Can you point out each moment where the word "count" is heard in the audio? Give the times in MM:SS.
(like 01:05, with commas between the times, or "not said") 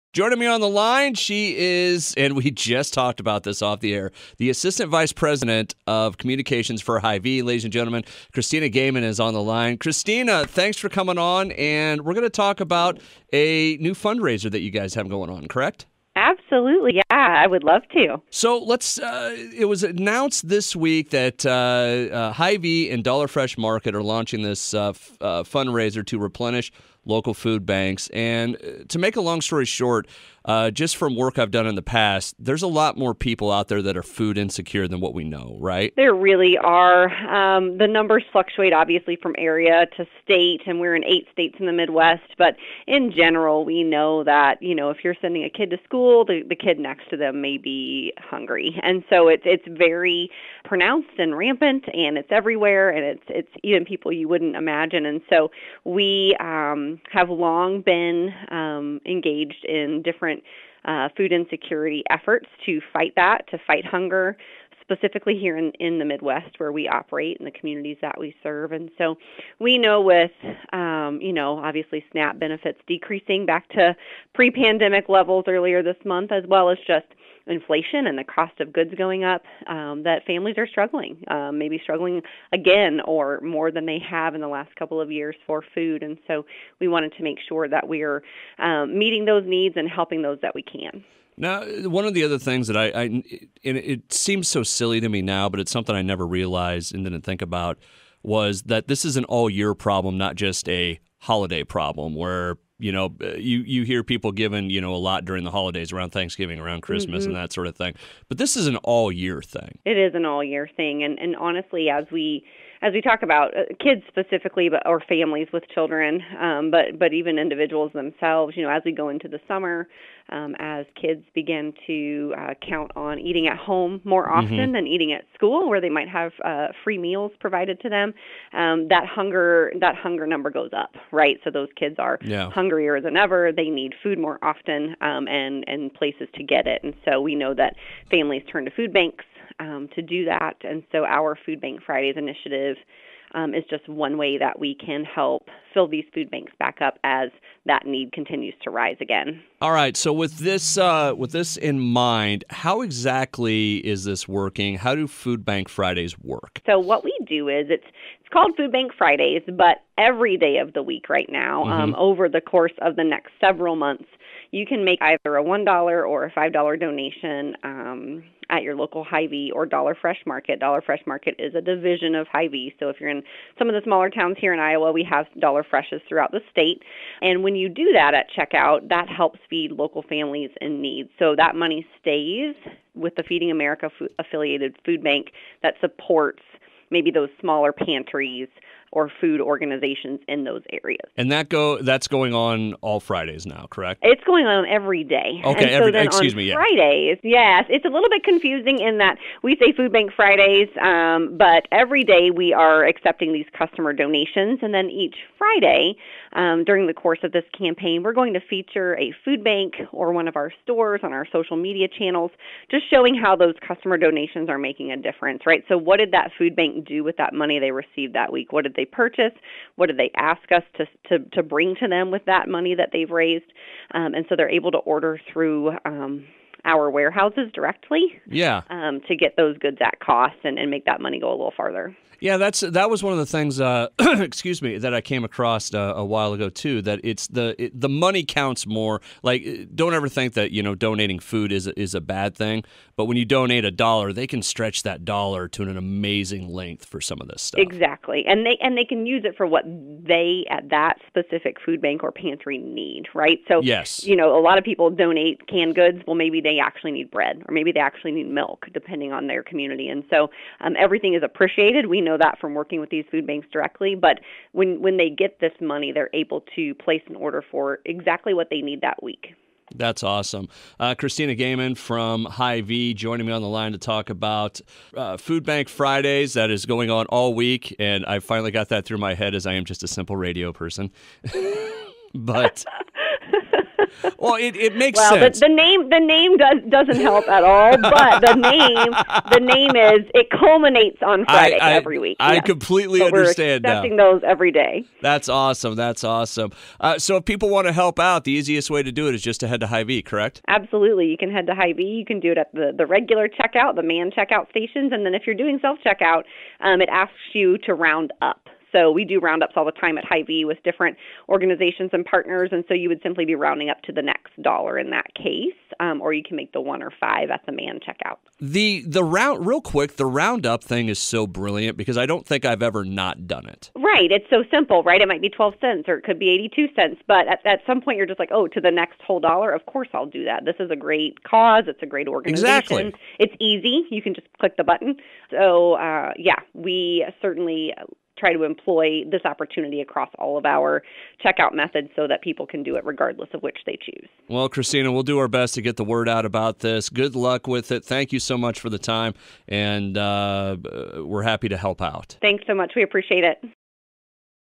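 02:02, 03:58.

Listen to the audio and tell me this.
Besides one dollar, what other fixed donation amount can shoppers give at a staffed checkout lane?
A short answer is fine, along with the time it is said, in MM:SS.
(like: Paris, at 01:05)
$5, at 02:46.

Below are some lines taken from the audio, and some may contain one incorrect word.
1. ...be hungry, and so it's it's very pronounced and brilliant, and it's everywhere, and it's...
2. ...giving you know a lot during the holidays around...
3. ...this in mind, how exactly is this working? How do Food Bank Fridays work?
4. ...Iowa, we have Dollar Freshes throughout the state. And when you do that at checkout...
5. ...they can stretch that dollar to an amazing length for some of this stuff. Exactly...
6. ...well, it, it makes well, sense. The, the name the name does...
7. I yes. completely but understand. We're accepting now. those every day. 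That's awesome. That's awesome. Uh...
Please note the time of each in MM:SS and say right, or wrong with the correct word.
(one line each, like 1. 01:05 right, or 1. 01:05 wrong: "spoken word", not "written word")
1. 00:47 wrong: "rampant", not "brilliant"
2. 01:44 right
3. 02:31 right
4. 02:54 right
5. 04:04 right
6. 04:44 right
7. 04:52 right.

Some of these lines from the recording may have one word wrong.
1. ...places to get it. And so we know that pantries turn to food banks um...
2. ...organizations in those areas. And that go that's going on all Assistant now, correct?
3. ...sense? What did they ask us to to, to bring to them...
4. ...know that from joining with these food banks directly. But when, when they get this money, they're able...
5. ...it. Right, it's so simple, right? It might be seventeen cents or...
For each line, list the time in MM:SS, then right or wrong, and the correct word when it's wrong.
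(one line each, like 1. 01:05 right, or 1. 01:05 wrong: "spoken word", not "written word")
1. 02:15 wrong: "families", not "pantries"
2. 03:09 wrong: "Fridays", not "Assistant"
3. 03:38 wrong: "purchase", not "sense"
4. 04:22 wrong: "working", not "joining"
5. 05:23 wrong: "twelve", not "seventeen".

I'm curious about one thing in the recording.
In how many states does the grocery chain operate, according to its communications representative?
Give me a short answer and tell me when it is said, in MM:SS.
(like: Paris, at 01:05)
8, at 00:41.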